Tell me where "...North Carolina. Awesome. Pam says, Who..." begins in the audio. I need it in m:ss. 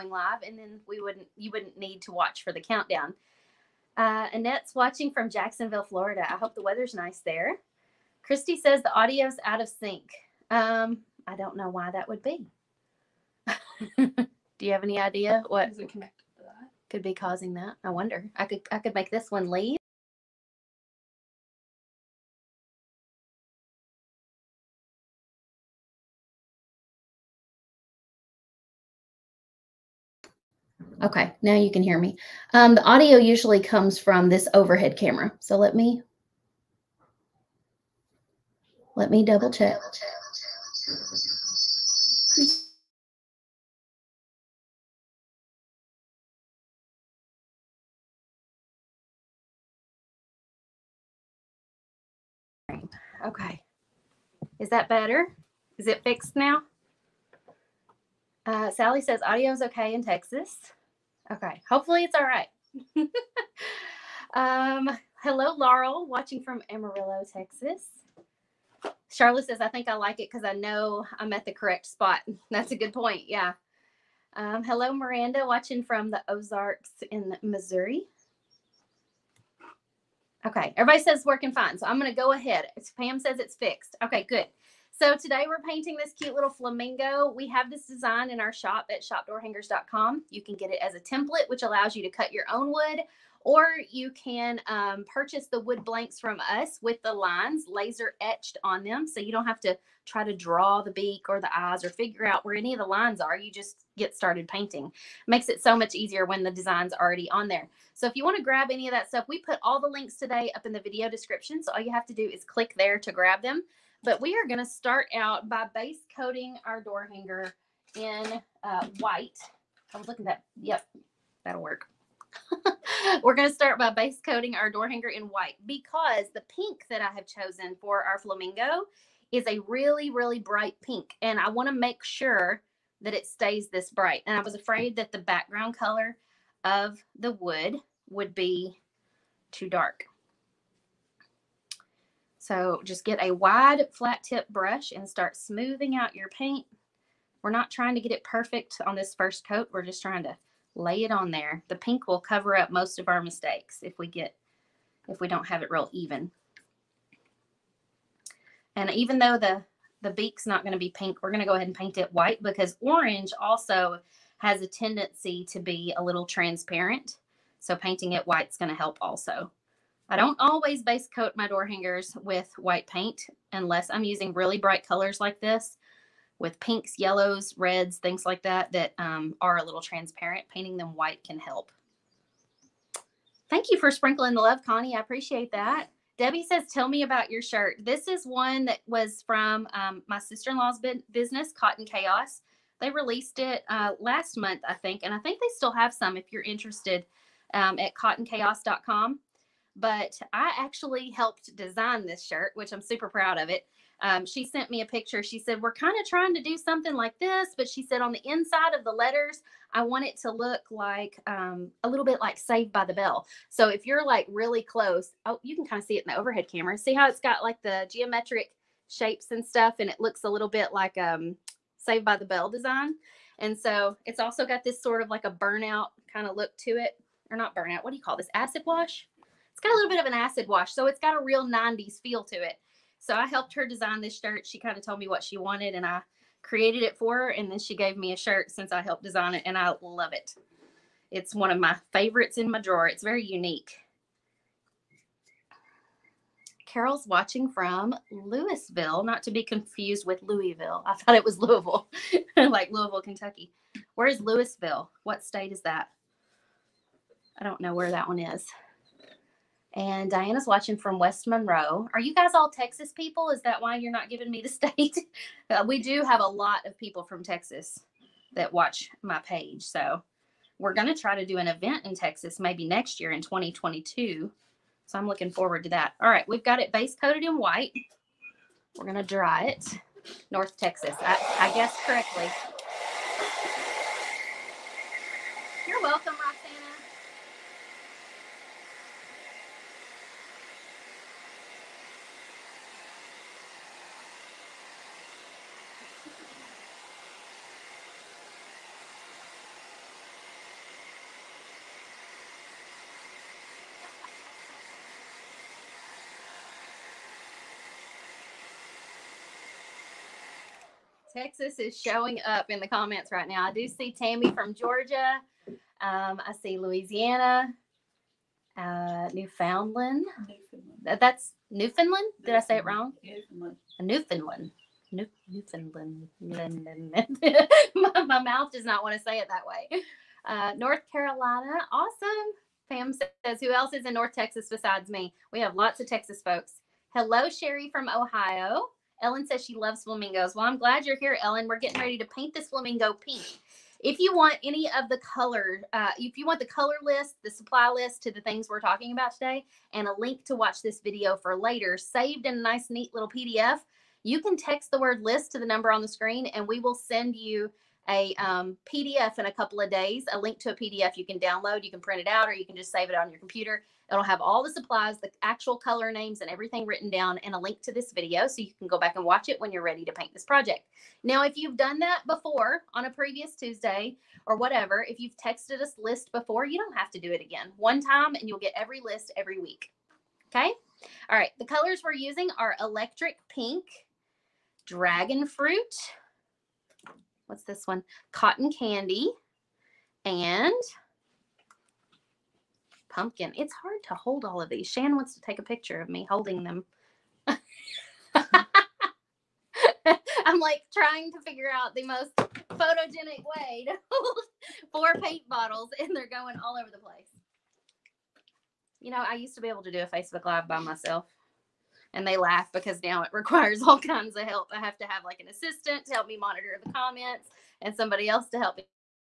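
5:30.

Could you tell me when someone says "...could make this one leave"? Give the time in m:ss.
0:18.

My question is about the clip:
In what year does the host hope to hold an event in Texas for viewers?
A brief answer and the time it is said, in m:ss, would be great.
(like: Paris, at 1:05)
2022, at 4:33.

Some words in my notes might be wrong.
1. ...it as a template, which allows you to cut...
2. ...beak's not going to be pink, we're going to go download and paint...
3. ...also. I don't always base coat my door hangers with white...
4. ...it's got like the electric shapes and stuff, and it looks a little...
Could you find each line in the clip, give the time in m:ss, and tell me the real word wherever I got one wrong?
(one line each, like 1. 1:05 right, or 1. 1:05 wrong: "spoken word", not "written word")
1. 1:30 right
2. 2:40 wrong: "ahead", not "download"
3. 2:49 right
4. 3:37 wrong: "geometric", not "electric".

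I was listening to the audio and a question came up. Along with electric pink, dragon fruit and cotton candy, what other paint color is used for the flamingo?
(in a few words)
pumpkin.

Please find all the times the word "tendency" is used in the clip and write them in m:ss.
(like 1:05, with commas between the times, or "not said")
2:44.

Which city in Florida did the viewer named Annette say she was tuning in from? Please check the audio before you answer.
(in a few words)
Jacksonville.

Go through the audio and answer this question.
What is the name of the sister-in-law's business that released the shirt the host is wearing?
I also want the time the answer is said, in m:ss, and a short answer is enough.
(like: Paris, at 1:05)
Cotton Chaos, at 3:11.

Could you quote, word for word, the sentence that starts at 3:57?
And then she gave me a shirt since I helped design it.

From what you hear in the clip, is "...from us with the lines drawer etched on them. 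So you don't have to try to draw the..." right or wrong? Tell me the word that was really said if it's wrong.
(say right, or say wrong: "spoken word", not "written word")
wrong: "laser", not "drawer".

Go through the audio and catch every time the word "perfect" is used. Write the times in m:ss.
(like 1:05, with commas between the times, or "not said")
2:28.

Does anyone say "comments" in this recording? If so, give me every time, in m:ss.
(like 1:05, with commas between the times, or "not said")
5:12, 6:56.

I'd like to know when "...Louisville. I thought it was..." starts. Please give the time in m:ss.
4:10.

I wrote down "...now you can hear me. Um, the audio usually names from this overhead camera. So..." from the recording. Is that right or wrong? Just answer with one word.
wrong.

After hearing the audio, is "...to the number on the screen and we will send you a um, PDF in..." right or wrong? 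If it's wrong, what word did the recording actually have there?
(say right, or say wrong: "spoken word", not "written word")
right.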